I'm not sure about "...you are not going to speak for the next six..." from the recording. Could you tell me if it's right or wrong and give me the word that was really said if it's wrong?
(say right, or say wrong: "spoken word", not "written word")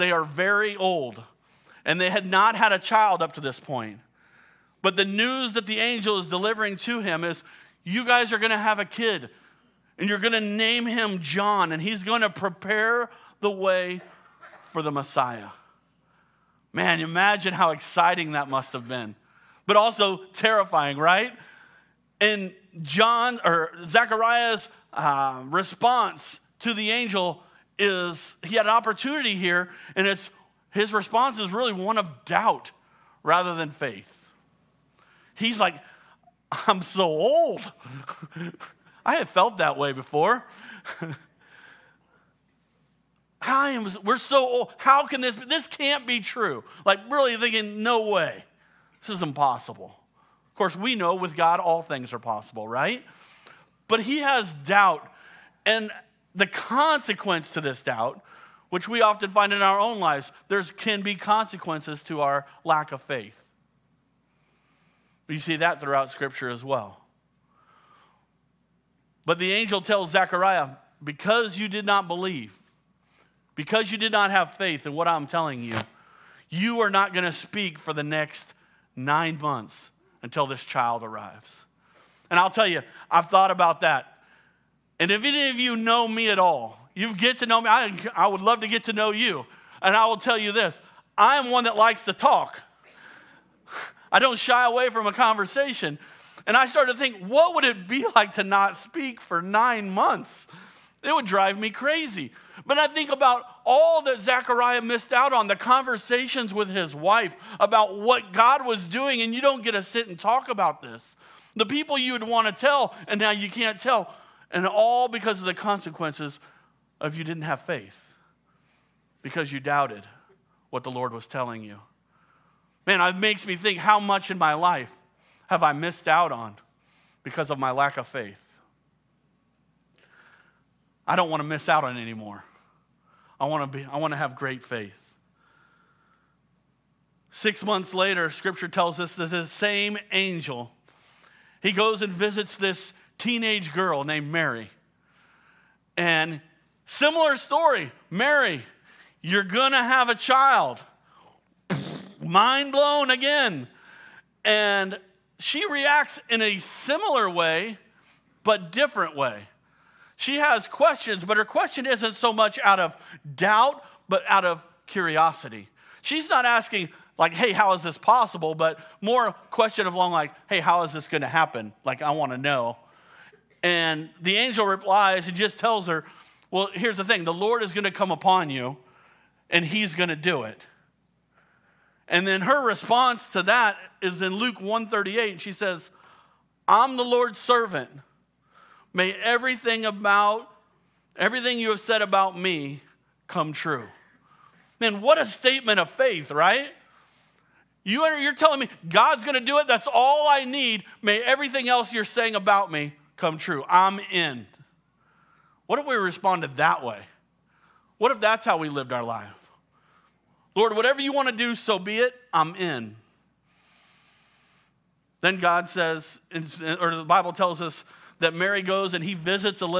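wrong: "nine", not "six".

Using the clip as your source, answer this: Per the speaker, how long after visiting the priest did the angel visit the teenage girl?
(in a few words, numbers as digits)
6 months.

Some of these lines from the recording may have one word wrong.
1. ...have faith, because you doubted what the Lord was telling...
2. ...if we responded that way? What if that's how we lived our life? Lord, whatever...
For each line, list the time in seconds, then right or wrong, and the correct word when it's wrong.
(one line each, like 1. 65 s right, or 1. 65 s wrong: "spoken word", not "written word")
1. 117 s right
2. 205 s right.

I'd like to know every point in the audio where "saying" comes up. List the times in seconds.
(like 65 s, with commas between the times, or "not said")
202 s.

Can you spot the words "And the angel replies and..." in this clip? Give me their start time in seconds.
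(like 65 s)
173 s.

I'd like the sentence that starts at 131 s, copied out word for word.
I don't want to miss out on anymore.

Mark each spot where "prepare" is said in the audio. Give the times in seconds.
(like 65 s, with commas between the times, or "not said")
12 s.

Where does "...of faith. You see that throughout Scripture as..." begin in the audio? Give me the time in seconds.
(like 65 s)
62 s.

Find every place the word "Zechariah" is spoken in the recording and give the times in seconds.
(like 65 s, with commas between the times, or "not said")
23 s, 70 s, 104 s.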